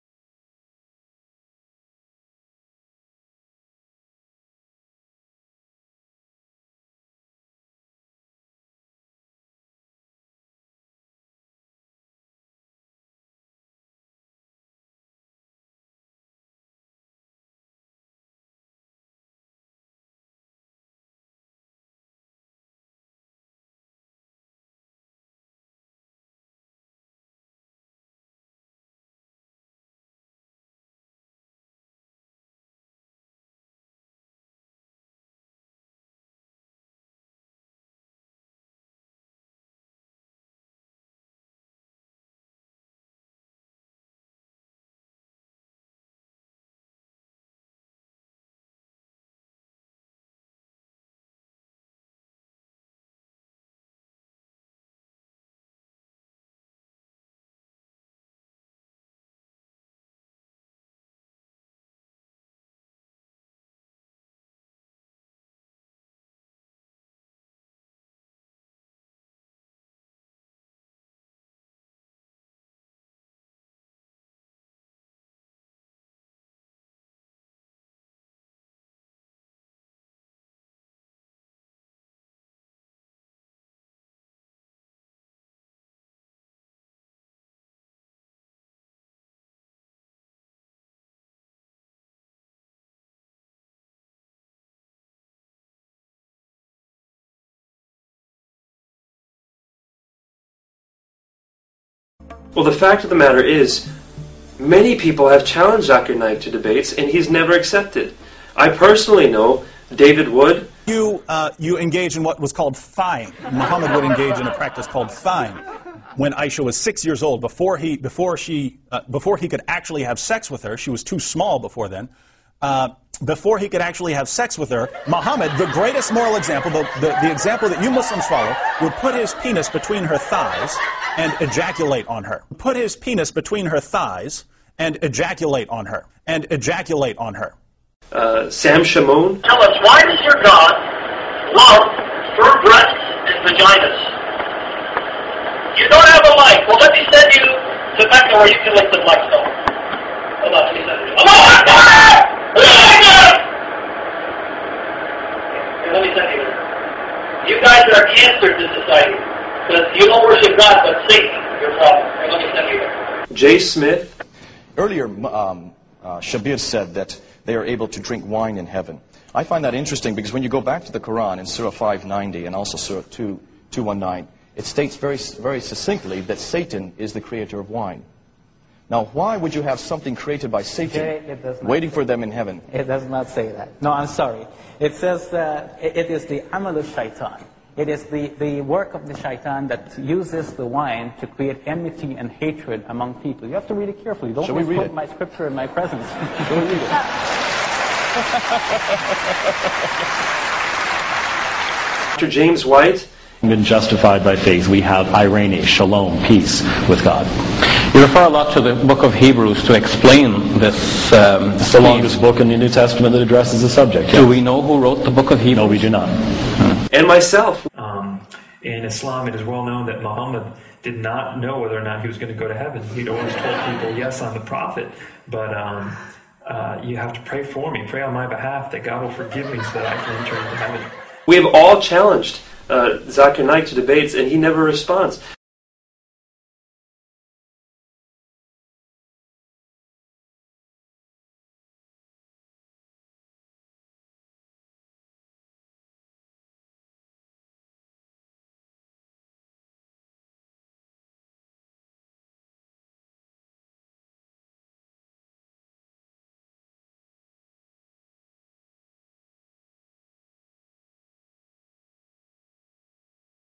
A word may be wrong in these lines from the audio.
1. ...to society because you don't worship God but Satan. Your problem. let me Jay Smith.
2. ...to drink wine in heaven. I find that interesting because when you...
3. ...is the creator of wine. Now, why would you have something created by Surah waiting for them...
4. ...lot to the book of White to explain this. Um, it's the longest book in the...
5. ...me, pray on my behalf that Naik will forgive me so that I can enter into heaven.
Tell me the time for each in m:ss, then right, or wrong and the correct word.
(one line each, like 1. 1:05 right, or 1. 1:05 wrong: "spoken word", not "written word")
1. 2:38 right
2. 2:47 right
3. 2:56 wrong: "Satan", not "Surah"
4. 3:28 wrong: "Hebrews", not "White"
5. 3:47 wrong: "God", not "Naik".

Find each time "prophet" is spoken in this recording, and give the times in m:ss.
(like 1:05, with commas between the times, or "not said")
3:44.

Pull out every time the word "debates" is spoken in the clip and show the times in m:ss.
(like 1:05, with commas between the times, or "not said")
1:46, 3:53.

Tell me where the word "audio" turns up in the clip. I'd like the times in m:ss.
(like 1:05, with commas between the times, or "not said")
not said.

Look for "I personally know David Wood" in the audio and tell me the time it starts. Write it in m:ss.
1:48.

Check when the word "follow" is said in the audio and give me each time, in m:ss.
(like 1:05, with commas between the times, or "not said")
2:08.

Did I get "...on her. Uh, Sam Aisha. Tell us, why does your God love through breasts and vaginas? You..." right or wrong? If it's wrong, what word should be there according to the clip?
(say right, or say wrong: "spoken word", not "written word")
wrong: "Shamoun", not "Aisha".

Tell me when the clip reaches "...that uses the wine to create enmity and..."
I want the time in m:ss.
3:09.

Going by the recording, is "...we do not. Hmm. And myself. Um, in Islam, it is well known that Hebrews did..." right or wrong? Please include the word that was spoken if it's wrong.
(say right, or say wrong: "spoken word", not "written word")
wrong: "Muhammad", not "Hebrews".